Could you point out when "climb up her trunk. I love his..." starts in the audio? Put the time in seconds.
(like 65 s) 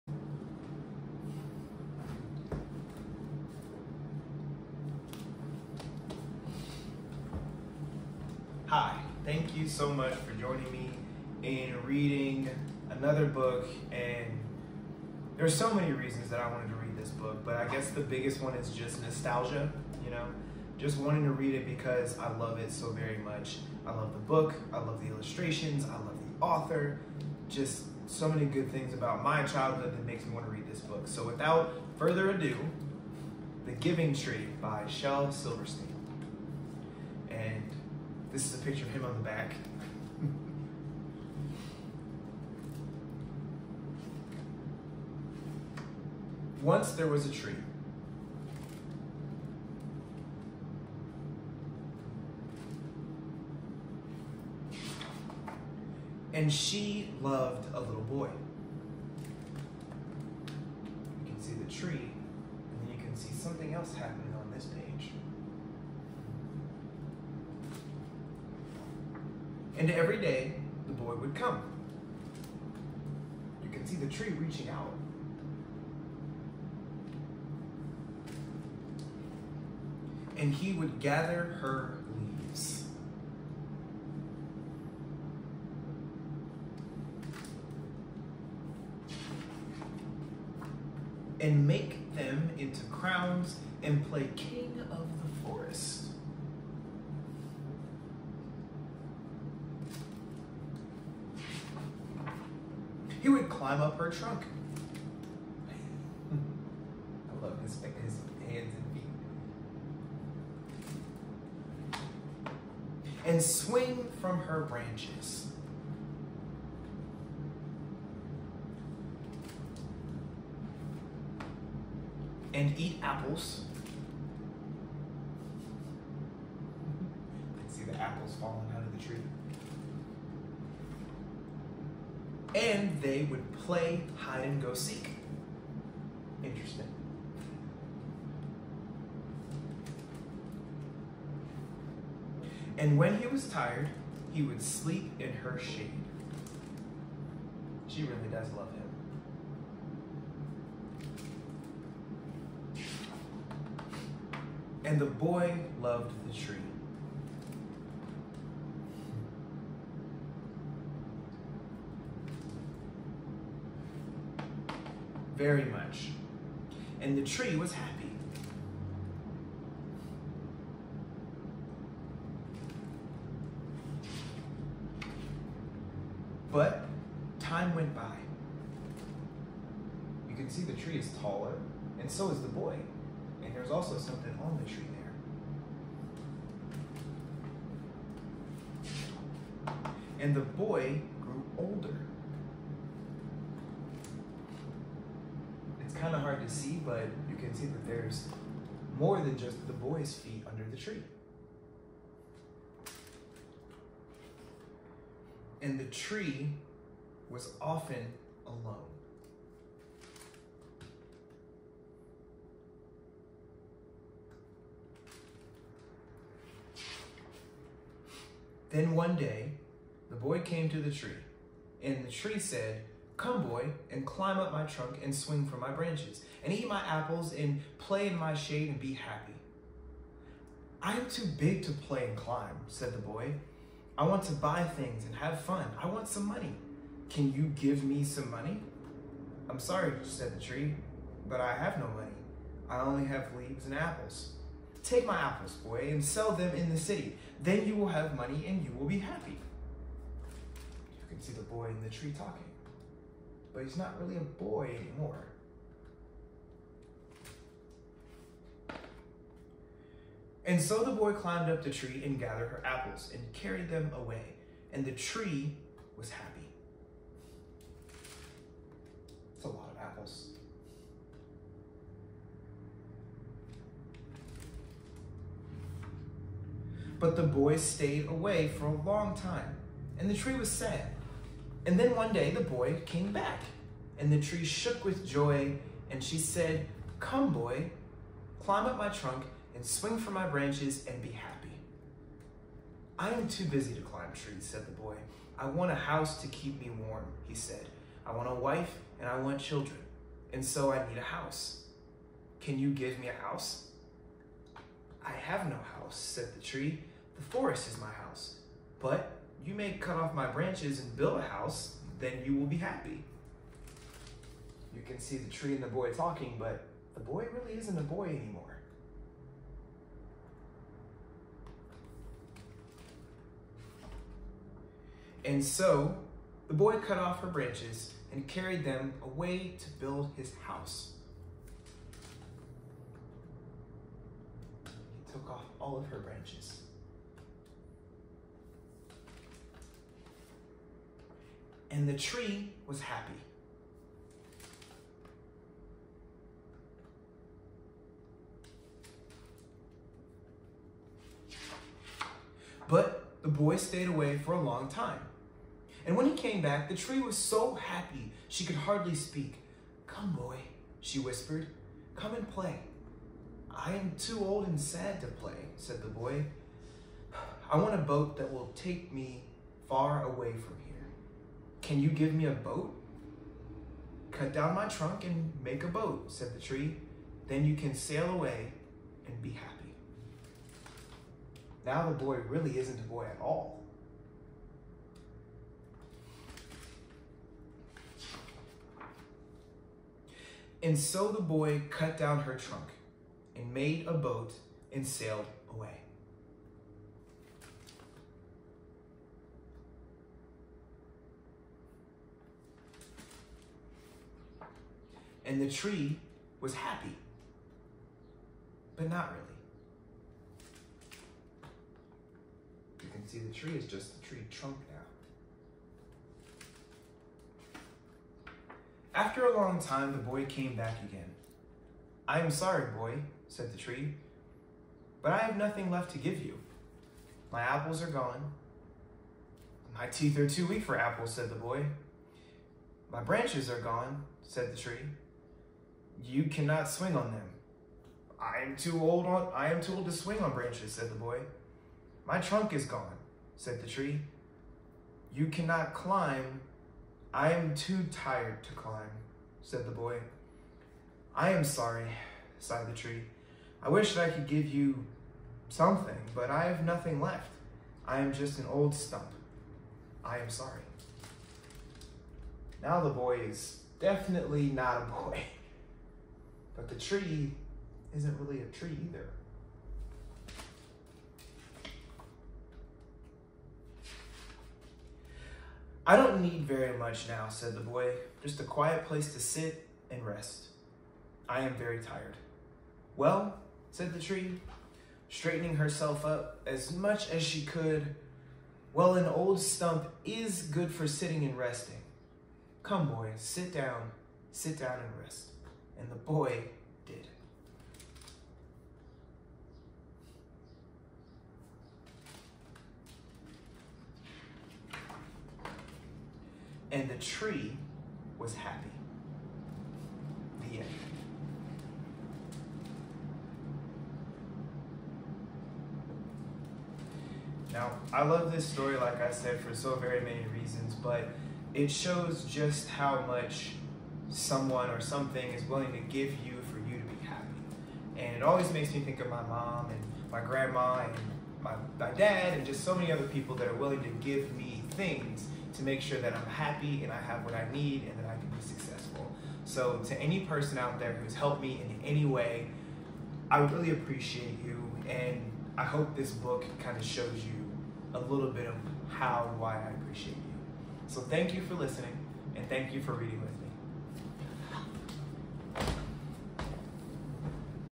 103 s.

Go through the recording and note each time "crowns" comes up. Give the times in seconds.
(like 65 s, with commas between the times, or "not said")
92 s.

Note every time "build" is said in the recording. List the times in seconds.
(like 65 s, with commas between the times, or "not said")
310 s, 329 s.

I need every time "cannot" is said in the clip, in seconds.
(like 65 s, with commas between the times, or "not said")
436 s, 445 s.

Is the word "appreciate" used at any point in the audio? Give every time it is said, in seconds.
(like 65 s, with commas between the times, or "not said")
543 s, 549 s.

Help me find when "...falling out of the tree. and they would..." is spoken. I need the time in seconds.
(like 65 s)
128 s.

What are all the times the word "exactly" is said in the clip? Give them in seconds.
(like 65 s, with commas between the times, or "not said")
not said.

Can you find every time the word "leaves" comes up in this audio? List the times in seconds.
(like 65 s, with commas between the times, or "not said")
82 s, 243 s.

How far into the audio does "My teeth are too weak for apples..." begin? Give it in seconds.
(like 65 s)
429 s.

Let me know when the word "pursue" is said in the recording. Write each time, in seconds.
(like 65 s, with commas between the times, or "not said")
not said.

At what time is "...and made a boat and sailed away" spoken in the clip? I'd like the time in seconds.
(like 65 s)
393 s.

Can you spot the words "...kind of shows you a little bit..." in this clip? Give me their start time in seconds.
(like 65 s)
546 s.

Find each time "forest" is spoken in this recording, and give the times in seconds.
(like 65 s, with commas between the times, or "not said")
95 s, 307 s.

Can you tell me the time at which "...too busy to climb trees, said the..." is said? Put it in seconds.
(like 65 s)
293 s.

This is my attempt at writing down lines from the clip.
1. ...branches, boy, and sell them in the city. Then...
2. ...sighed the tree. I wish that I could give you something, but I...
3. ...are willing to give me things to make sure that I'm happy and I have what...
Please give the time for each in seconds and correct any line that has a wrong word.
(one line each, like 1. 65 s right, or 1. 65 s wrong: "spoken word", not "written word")
1. 245 s wrong: "apples", not "branches"
2. 452 s right
3. 533 s right.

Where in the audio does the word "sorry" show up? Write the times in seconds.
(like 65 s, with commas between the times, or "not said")
239 s, 422 s, 451 s, 460 s.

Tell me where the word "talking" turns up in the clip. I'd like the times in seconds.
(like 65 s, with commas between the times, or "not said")
252 s, 315 s.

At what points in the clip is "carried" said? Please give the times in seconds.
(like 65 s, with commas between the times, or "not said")
263 s, 328 s.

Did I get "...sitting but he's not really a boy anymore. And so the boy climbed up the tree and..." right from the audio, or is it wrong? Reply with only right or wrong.
wrong.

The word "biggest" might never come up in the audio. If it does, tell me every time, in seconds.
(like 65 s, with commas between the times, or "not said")
17 s.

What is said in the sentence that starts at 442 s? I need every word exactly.
My trunk is gone, said the tree.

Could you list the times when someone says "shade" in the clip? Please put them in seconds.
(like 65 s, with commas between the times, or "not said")
145 s, 228 s.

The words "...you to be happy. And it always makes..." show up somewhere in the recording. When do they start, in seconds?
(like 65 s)
526 s.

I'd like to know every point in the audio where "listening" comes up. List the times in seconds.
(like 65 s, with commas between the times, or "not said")
551 s.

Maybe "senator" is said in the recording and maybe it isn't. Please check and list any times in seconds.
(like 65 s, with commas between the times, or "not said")
not said.